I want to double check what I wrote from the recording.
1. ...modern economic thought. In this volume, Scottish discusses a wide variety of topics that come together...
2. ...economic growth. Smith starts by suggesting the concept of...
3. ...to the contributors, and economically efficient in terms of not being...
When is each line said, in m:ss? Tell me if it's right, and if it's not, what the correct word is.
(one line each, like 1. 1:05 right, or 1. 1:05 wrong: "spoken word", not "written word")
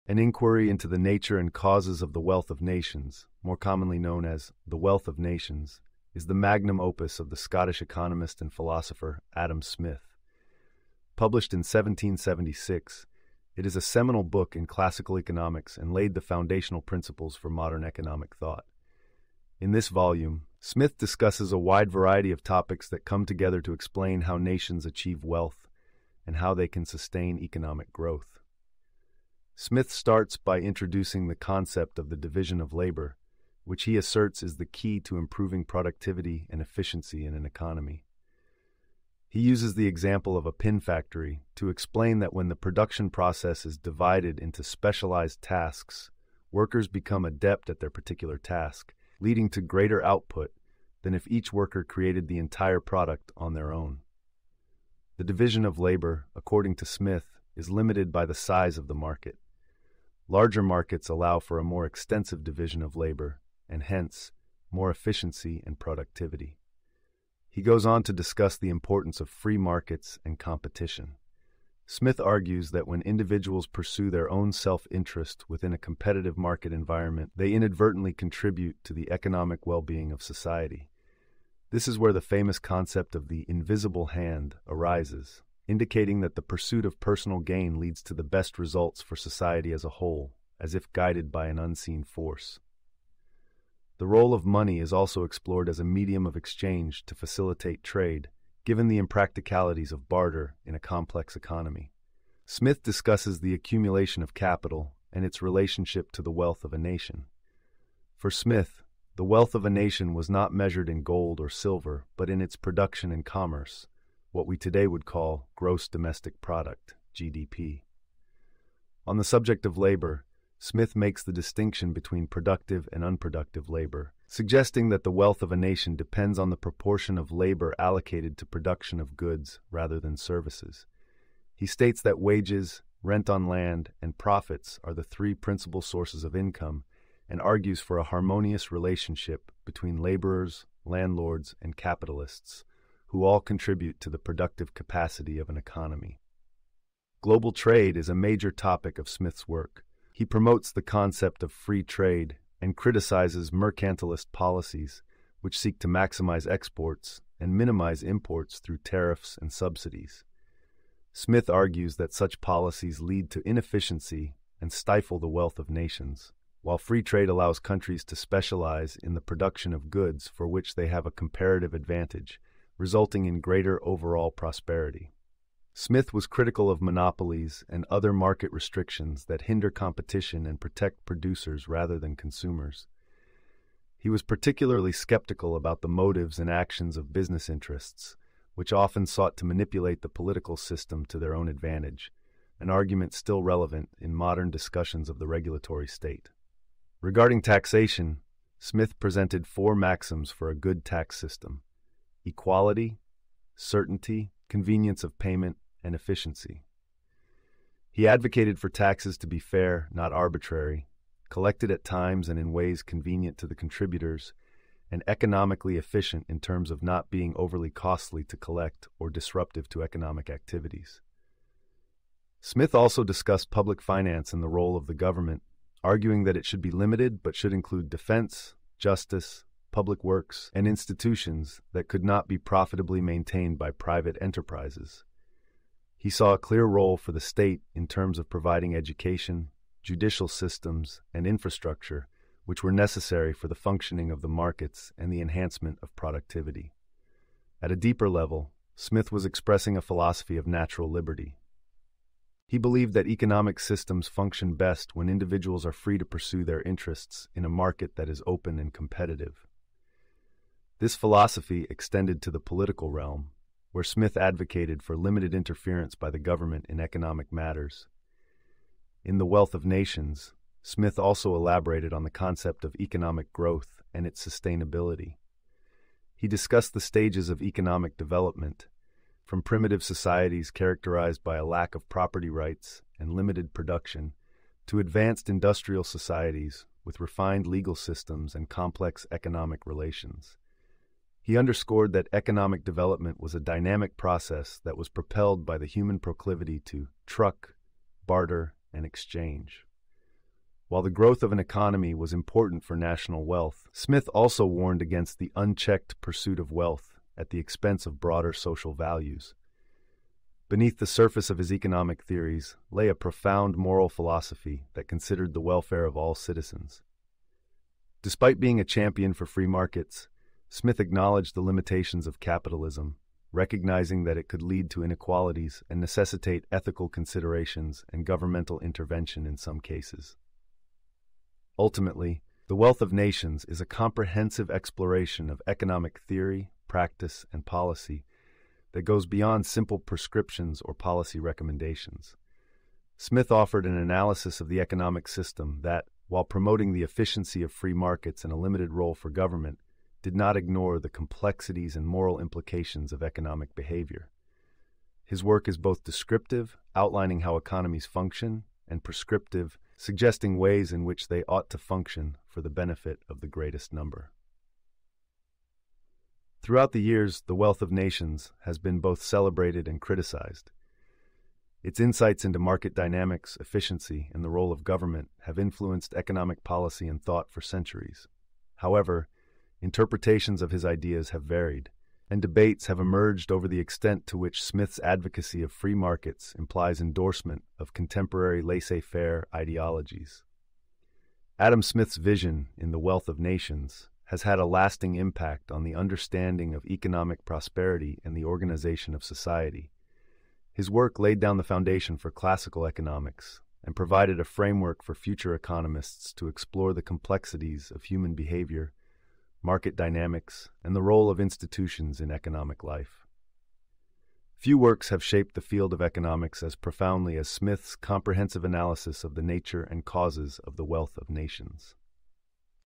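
1. 0:17 wrong: "Smith", not "Scottish"
2. 0:27 wrong: "introducing", not "suggesting"
3. 3:33 right.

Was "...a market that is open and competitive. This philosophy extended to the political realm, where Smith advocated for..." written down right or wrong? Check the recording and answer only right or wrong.
right.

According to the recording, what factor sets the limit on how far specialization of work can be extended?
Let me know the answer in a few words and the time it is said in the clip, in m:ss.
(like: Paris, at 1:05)
Size of the market, at 0:58.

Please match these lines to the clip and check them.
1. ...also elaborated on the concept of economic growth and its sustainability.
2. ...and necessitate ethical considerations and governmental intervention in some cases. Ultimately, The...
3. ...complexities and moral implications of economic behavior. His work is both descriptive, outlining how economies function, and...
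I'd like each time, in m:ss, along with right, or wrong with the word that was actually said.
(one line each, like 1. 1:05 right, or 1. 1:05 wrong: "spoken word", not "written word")
1. 4:30 right
2. 5:25 right
3. 5:50 right.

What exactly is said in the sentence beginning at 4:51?
He underscored that economic development was a dynamic process that was propelled by the human proclivity to truck, barter, and exchange.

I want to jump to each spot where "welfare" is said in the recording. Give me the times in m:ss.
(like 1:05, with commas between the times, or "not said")
5:15.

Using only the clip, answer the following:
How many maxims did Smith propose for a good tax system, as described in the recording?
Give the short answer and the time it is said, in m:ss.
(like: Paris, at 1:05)
4, at 3:19.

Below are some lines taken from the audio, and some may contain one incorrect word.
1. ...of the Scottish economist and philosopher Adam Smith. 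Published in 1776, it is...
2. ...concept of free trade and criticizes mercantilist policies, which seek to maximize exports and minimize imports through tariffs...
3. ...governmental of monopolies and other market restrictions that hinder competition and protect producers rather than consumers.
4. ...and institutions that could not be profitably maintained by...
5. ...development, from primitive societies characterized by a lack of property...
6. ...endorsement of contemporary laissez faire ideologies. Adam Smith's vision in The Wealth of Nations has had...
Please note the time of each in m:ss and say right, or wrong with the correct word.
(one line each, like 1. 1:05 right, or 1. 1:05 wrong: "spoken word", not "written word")
1. 0:07 right
2. 2:30 right
3. 2:56 wrong: "critical", not "governmental"
4. 3:50 right
5. 4:37 right
6. 6:26 right.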